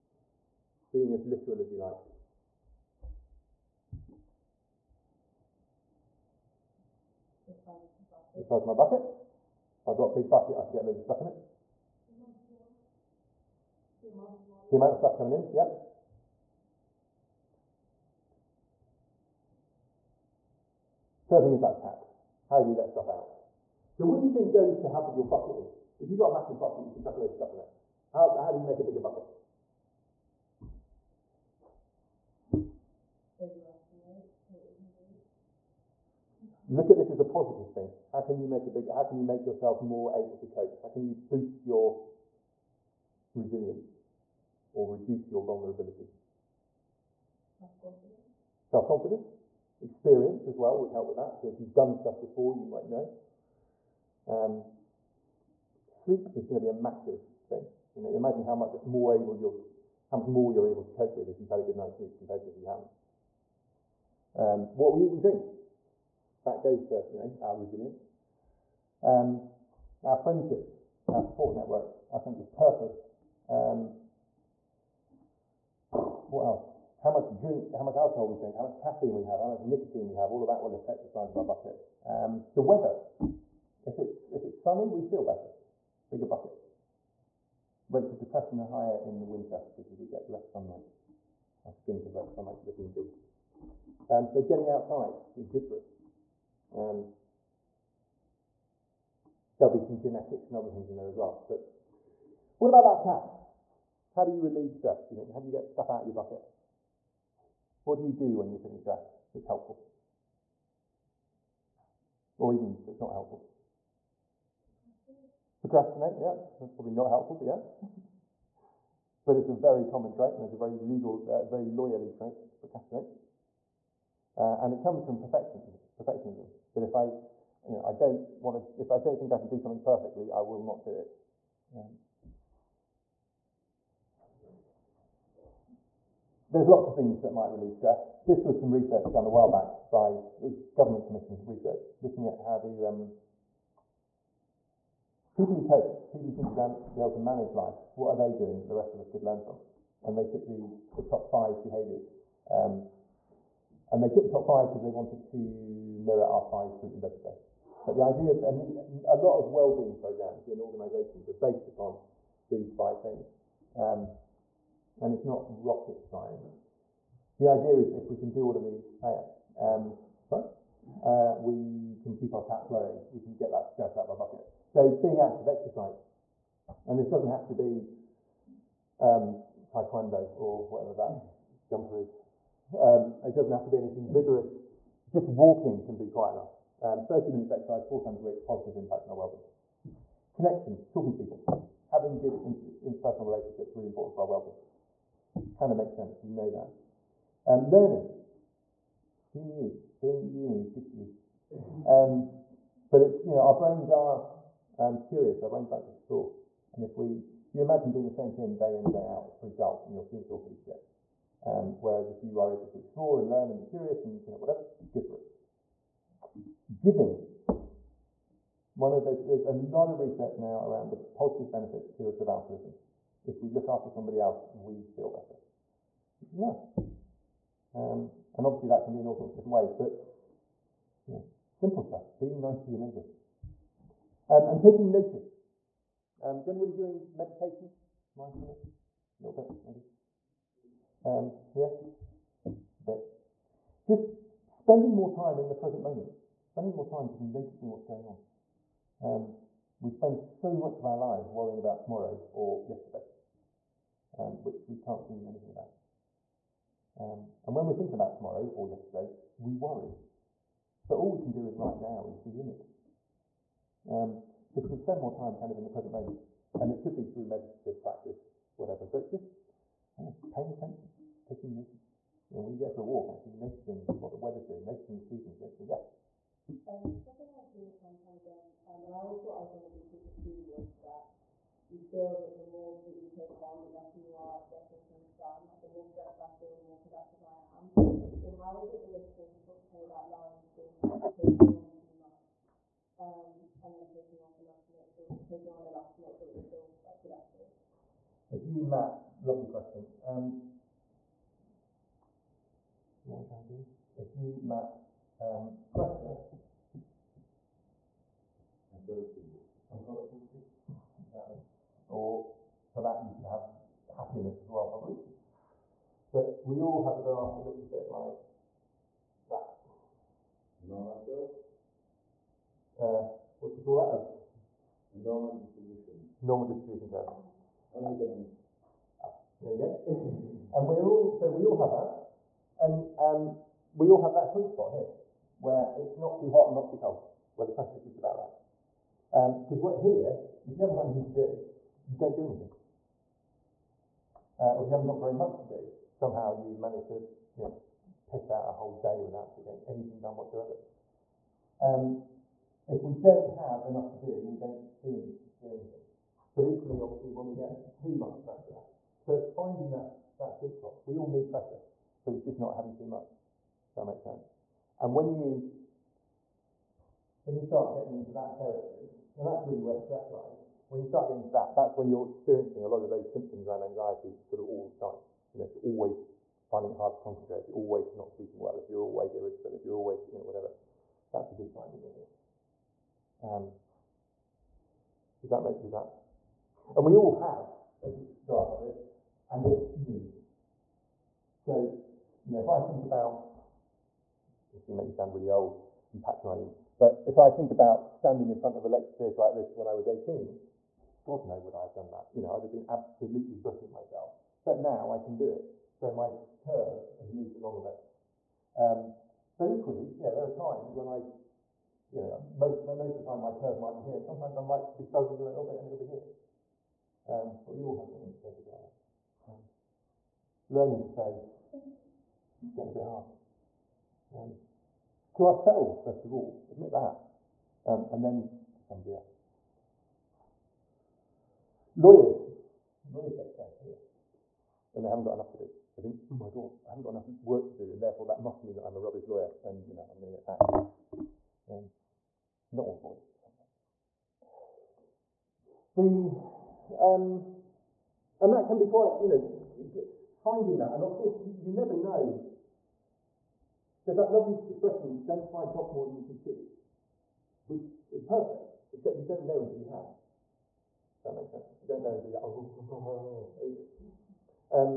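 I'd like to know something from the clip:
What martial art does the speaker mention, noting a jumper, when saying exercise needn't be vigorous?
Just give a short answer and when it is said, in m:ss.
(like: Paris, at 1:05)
Taekwondo, at 2:59.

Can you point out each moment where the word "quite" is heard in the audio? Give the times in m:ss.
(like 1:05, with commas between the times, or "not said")
3:06, 7:28.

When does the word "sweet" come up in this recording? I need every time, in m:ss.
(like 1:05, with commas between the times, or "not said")
5:34, 6:00.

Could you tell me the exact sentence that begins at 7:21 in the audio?
Um, not all lawyers, but sometimes.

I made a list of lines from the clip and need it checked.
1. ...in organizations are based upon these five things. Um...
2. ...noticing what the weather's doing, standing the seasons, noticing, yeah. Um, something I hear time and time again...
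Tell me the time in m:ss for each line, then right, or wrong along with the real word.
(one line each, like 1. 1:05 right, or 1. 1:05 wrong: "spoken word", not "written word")
1. 2:40 right
2. 4:33 wrong: "noticing", not "standing".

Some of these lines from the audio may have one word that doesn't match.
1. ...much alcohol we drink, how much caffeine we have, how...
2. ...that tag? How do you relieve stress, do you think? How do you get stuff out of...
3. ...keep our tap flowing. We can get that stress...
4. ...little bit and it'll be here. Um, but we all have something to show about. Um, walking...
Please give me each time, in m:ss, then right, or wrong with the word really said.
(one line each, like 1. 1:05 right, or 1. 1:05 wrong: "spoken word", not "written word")
1. 1:17 right
2. 1:42 right
3. 2:52 right
4. 6:55 wrong: "learning", not "walking".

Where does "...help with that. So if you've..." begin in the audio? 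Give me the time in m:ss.
0:50.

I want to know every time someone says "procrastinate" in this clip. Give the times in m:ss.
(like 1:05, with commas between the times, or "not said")
1:55, 2:02.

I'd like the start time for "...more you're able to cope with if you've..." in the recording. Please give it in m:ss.
1:00.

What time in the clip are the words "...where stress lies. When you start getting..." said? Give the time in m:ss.
6:09.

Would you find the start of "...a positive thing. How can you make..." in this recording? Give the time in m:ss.
0:37.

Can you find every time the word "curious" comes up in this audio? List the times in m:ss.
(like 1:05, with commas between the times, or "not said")
3:25, 3:33.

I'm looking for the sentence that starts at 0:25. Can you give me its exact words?
If you've got a massive bucket, you can chuck a load of stuff in it.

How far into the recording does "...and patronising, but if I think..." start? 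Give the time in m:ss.
6:35.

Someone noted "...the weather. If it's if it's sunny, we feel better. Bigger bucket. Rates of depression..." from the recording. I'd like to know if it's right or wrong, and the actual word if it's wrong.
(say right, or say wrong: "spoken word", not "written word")
right.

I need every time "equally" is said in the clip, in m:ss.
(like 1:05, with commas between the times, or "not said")
5:56, 6:49.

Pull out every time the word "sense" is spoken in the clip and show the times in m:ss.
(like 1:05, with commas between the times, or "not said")
1:12, 3:15, 6:04, 7:41.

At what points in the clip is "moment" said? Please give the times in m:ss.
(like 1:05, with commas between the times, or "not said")
4:05, 4:25.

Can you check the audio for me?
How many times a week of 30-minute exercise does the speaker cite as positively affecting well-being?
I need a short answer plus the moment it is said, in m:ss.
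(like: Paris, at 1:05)
4, at 3:07.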